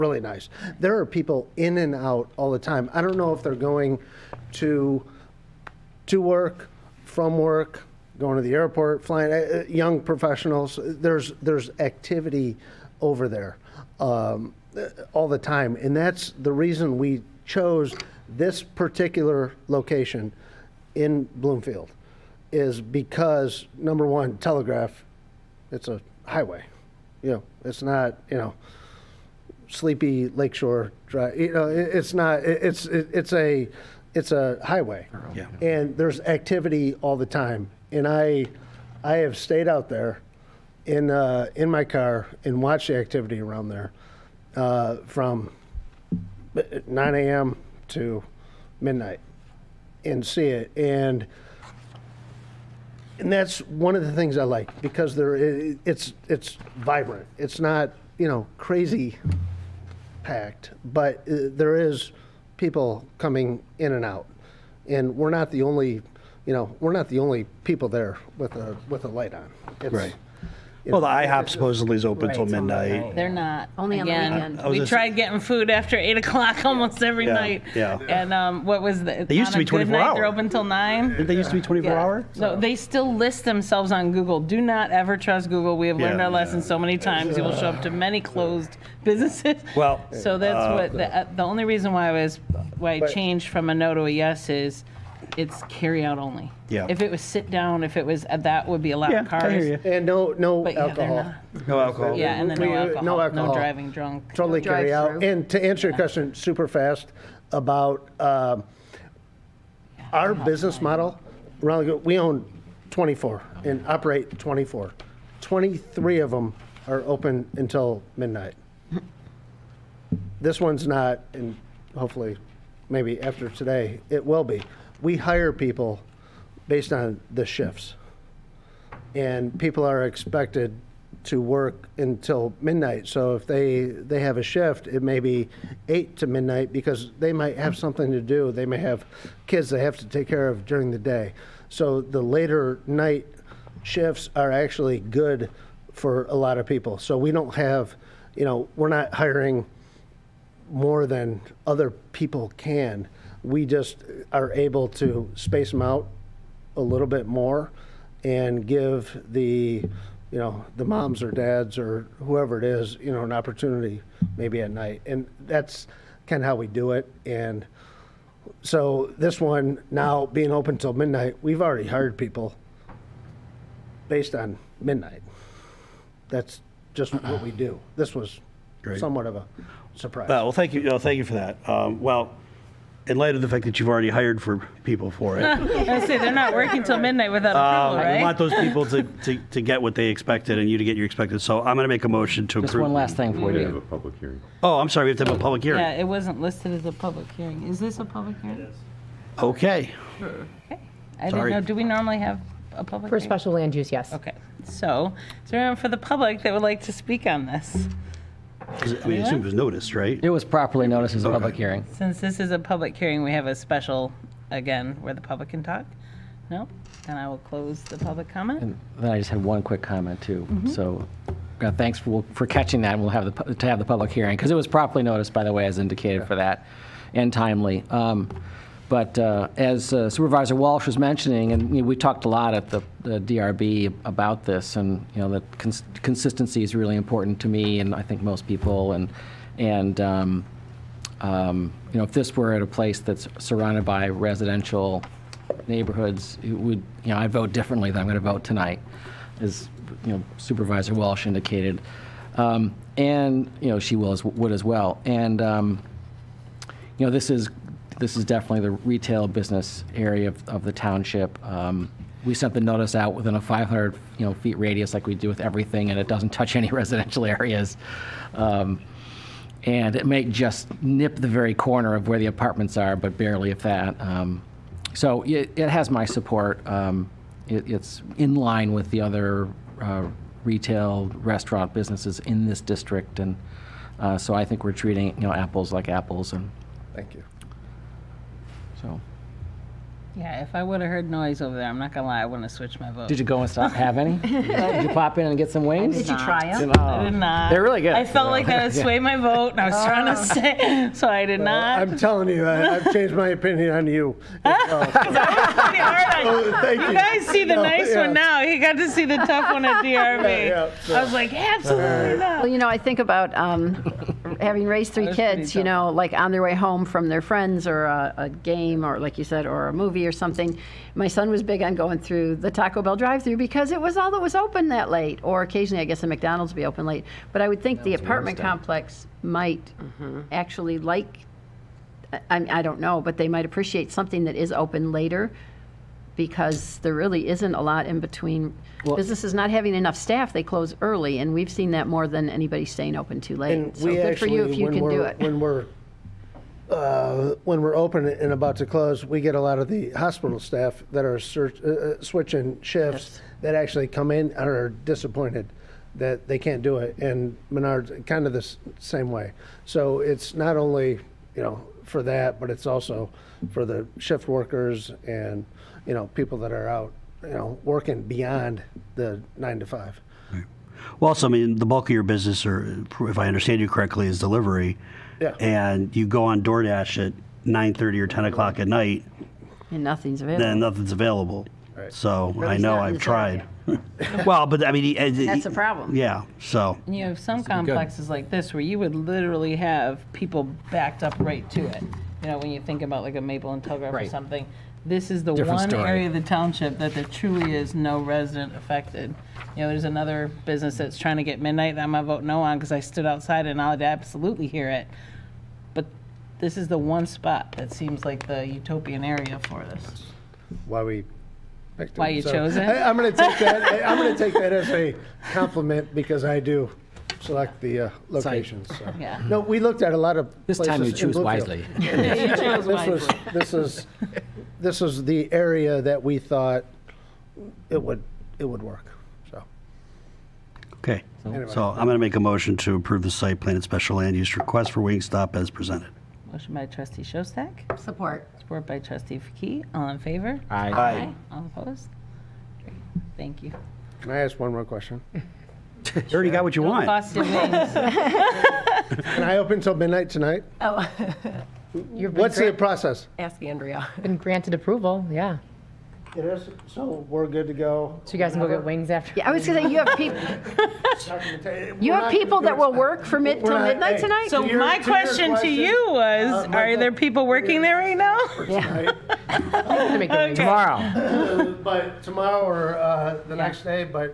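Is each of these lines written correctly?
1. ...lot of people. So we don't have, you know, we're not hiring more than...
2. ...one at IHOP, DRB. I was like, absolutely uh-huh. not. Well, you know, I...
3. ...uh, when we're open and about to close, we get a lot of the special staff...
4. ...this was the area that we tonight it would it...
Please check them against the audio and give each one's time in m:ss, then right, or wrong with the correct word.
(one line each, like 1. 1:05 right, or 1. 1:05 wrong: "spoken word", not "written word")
1. 2:26 right
2. 5:09 wrong: "Yeah", not "IHOP"
3. 5:46 wrong: "hospital", not "special"
4. 7:04 wrong: "thought", not "tonight".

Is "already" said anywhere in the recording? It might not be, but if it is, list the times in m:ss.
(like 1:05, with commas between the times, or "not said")
2:51, 3:03, 7:26.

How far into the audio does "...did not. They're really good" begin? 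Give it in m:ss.
4:57.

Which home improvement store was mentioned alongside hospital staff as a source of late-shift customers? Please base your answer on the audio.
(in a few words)
Menard's.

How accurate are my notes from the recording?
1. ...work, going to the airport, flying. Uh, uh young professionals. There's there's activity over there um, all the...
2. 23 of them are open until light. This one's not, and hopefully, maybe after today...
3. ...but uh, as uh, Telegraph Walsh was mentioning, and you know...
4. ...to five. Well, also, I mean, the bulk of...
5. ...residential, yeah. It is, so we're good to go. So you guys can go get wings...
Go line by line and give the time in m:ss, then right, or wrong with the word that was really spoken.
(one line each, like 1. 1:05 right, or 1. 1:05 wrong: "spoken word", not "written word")
1. 0:07 right
2. 1:55 wrong: "midnight", not "light"
3. 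3:48 wrong: "Supervisor", not "Telegraph"
4. 6:09 right
5. 7:34 wrong: "approval", not "residential".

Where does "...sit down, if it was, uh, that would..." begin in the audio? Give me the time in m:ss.
1:37.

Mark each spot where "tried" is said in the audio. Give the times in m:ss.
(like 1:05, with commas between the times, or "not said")
1:14, 6:22.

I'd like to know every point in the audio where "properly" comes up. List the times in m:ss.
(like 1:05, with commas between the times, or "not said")
3:30, 3:44.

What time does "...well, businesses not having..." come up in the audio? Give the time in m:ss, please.
5:38.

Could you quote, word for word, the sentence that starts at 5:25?
Or occasionally, I guess, a McDonald's would be open late.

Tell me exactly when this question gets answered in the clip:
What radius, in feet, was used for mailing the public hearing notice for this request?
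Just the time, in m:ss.
4:23.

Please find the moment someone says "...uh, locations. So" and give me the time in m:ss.
6:57.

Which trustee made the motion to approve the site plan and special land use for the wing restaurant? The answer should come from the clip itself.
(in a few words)
Schostak.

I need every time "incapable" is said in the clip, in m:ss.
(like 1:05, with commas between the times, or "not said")
not said.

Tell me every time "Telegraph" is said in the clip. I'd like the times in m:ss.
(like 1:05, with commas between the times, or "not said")
0:24, 6:33.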